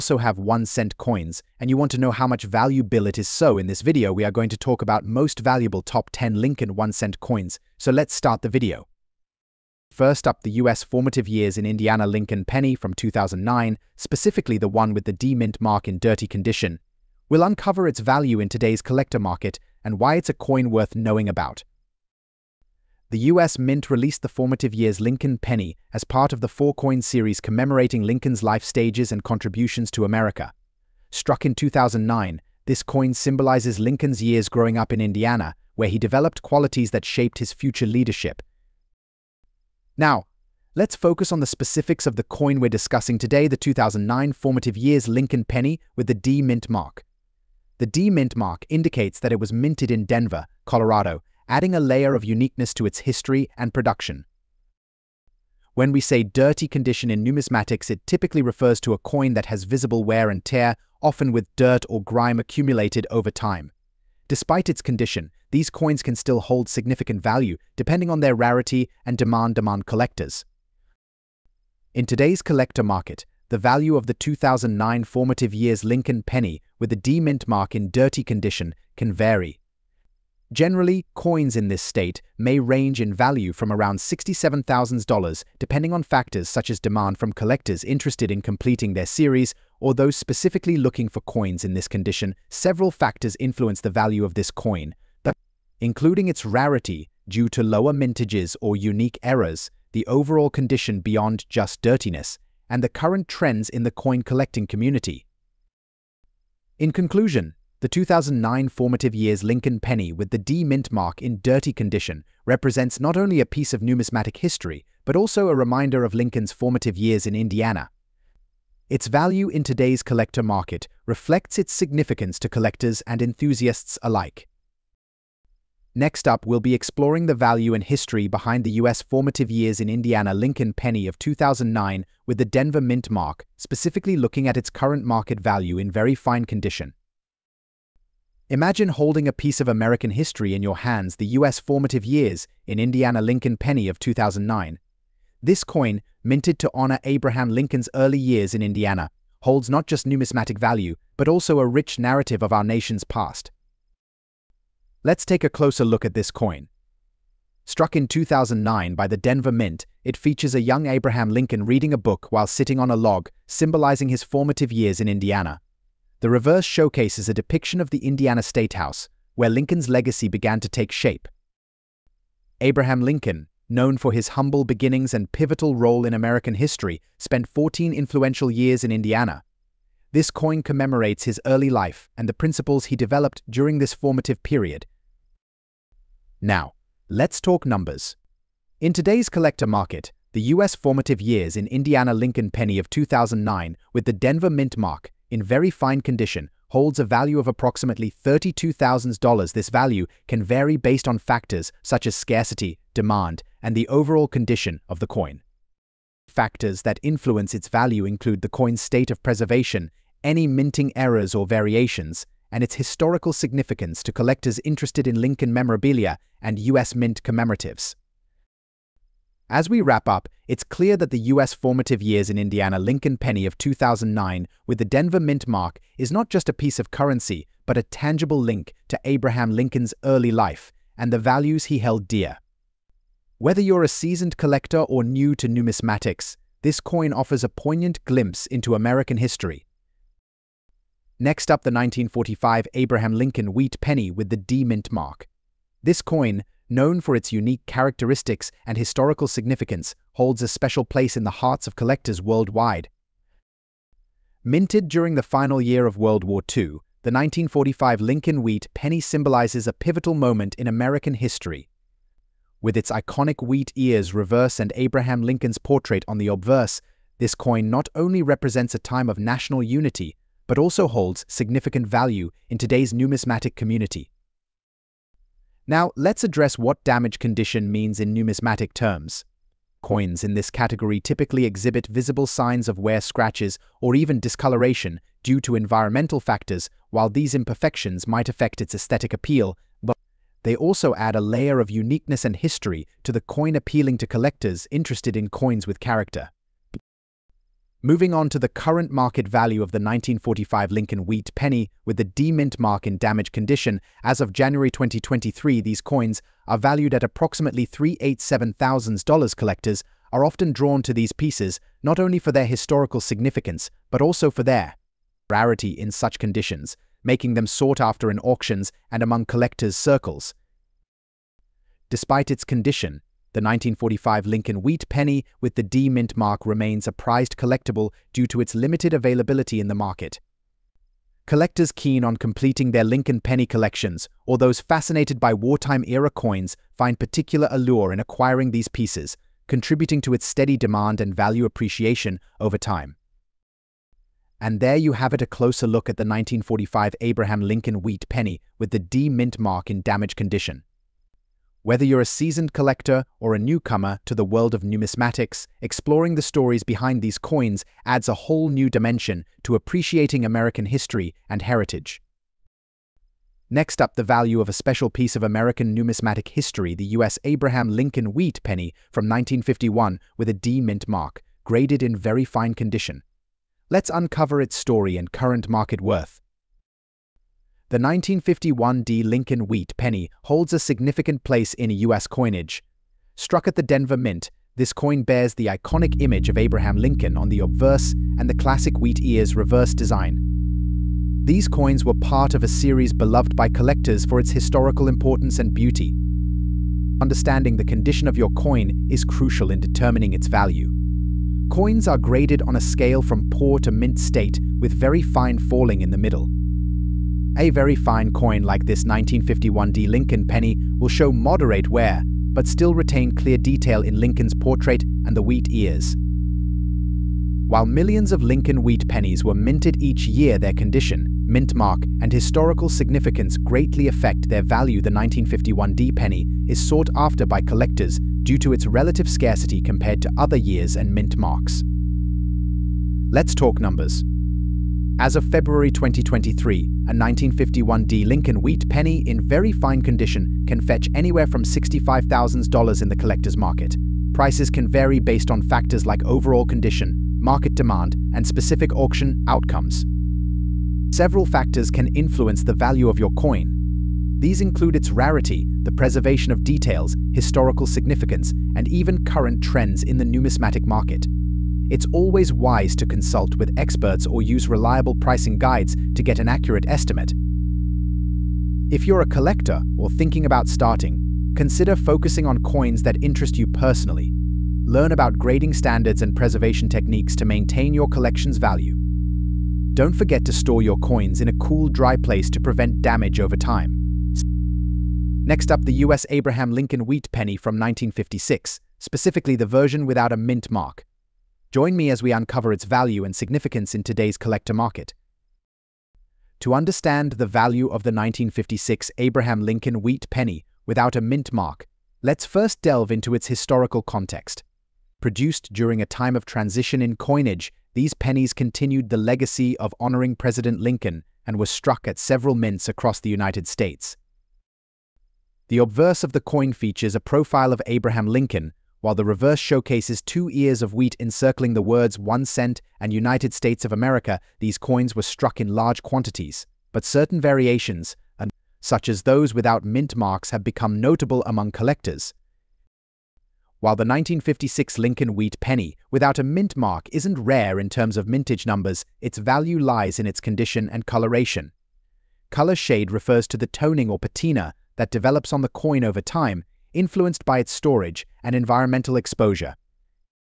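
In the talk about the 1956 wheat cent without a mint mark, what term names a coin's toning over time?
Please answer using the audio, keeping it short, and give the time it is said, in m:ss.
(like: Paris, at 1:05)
Color shade, at 9:02.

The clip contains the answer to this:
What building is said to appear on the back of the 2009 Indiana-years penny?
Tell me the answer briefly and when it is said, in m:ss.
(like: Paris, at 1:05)
Indiana State House, at 2:48.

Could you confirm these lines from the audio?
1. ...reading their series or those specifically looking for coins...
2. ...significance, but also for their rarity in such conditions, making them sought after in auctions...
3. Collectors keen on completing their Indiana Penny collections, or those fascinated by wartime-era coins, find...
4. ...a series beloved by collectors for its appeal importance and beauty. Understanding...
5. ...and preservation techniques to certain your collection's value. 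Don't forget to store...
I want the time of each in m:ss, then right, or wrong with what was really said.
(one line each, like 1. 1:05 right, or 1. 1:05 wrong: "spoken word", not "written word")
1. 1:28 wrong: "completing", not "reading"
2. 5:13 right
3. 5:31 wrong: "Lincoln", not "Indiana"
4. 6:32 wrong: "historical", not "appeal"
5. 7:56 wrong: "maintain", not "certain".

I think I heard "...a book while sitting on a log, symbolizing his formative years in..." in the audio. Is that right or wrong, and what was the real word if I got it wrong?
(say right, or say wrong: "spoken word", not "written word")
right.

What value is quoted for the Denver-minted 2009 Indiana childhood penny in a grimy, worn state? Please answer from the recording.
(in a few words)
$67,000.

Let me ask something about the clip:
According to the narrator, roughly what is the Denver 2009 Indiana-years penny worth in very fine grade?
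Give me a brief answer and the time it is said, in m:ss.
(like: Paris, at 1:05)
$32,000, at 3:18.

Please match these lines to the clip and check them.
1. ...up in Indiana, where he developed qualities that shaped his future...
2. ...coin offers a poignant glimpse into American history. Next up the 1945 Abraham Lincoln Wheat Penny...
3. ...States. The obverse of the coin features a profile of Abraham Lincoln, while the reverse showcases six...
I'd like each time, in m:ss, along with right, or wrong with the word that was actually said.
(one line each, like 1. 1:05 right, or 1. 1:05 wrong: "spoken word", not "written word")
1. 0:34 right
2. 3:56 right
3. 8:33 wrong: "two", not "six".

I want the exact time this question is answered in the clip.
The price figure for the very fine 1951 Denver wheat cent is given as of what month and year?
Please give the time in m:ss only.
7:15.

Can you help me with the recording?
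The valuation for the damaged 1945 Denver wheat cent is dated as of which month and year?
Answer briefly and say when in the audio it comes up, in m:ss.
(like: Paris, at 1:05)
January 2023, at 5:04.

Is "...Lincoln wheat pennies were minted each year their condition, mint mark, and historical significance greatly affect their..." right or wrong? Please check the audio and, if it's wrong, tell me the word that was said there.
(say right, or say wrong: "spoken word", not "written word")
right.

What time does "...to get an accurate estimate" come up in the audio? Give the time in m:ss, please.
7:45.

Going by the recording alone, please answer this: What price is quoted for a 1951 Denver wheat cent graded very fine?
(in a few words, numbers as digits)
$65,000.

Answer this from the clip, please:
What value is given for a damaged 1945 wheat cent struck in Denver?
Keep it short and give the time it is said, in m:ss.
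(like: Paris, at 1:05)
$387,000, at 5:07.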